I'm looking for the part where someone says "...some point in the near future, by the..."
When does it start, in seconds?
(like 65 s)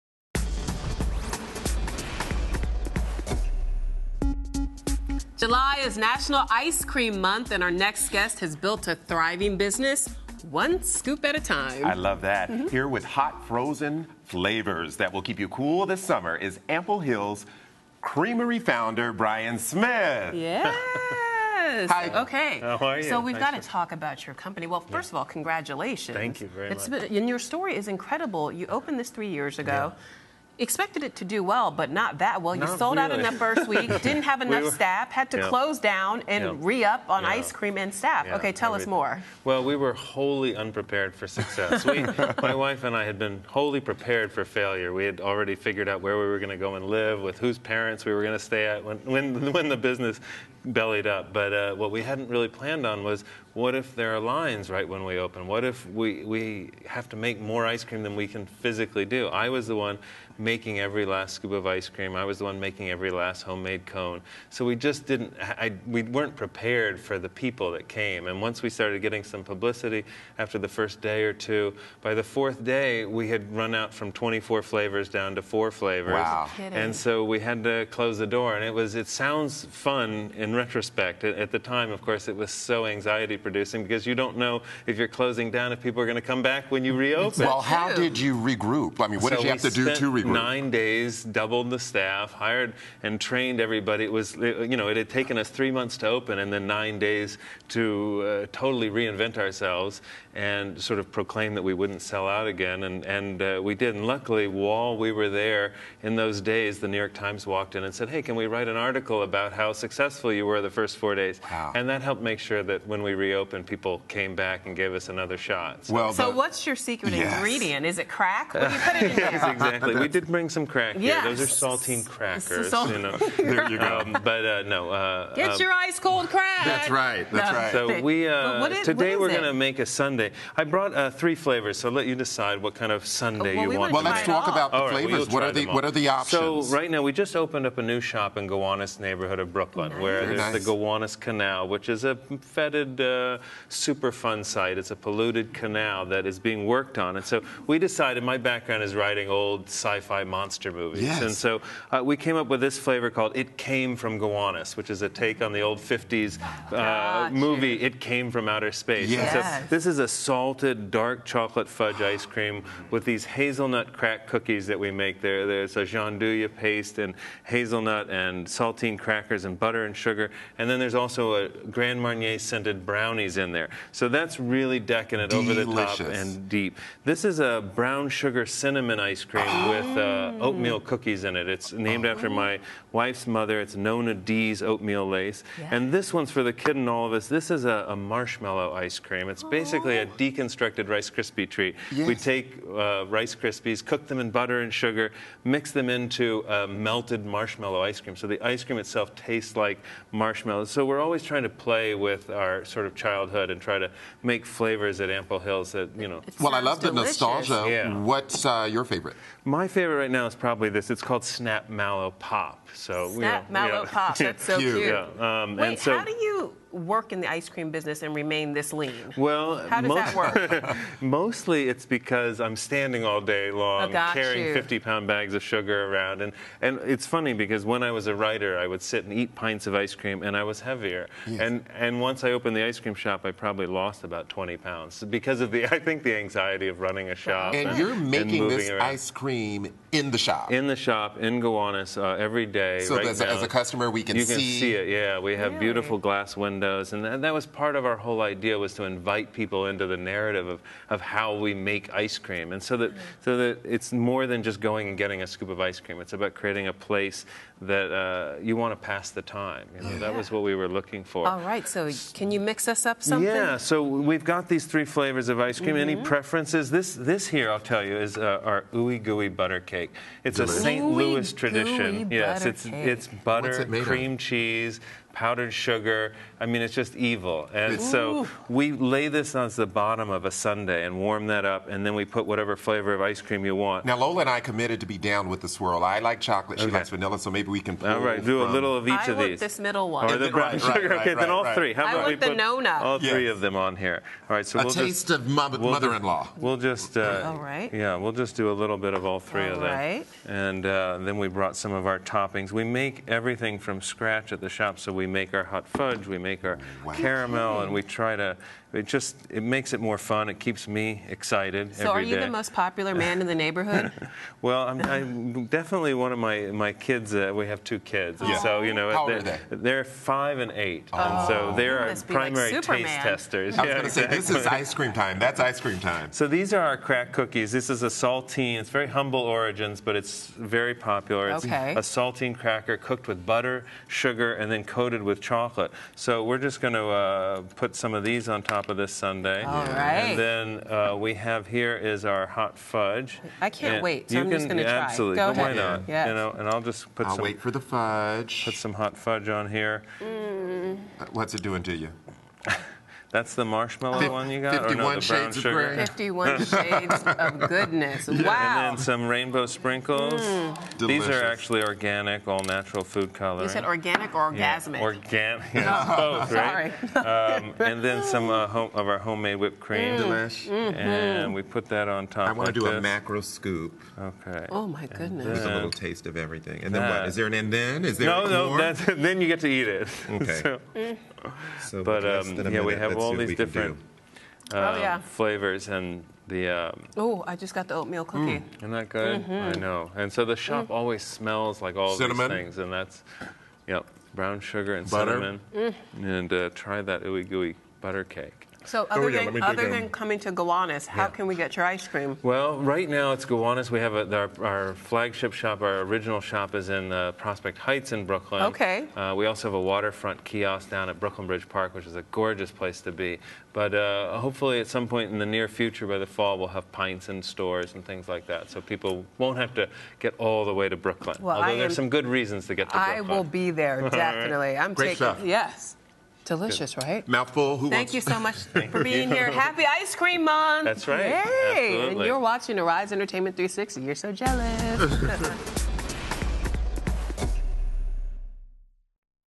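414 s.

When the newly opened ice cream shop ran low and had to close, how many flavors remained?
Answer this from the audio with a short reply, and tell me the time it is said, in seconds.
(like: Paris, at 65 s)
4, at 75 s.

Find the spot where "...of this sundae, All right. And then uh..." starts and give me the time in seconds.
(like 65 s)
338 s.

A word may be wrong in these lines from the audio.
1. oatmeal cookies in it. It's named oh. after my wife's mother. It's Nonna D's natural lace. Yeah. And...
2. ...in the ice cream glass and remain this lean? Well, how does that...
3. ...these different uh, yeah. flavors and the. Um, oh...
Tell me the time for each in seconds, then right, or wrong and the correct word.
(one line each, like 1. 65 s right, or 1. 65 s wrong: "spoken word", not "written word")
1. 180 s wrong: "oatmeal", not "natural"
2. 217 s wrong: "business", not "glass"
3. 383 s right.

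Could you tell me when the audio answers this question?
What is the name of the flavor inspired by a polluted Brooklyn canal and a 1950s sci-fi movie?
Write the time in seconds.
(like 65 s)
153 s.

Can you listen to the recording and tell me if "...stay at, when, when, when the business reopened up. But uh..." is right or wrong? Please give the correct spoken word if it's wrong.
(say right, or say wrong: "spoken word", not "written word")
wrong: "bellied", not "reopened".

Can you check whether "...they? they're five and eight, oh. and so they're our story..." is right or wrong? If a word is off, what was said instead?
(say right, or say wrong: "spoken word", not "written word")
wrong: "primary", not "story".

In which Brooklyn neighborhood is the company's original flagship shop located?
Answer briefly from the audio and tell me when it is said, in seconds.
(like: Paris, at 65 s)
Prospect Heights, at 407 s.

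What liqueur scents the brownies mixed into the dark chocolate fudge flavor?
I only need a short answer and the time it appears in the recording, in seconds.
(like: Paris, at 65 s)
Grand Marnier, at 171 s.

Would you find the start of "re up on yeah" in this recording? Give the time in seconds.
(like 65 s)
36 s.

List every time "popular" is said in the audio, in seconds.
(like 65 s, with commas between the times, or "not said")
312 s, 330 s.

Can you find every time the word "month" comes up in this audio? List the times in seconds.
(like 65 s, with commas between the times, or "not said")
7 s, 95 s, 430 s.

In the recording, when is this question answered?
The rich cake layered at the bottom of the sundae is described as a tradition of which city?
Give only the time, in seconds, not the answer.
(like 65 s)
270 s.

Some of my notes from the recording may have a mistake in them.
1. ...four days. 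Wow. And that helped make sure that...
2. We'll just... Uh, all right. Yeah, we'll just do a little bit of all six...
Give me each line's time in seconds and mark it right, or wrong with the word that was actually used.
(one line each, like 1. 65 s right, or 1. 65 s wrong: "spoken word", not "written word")
1. 110 s right
2. 296 s wrong: "three", not "six".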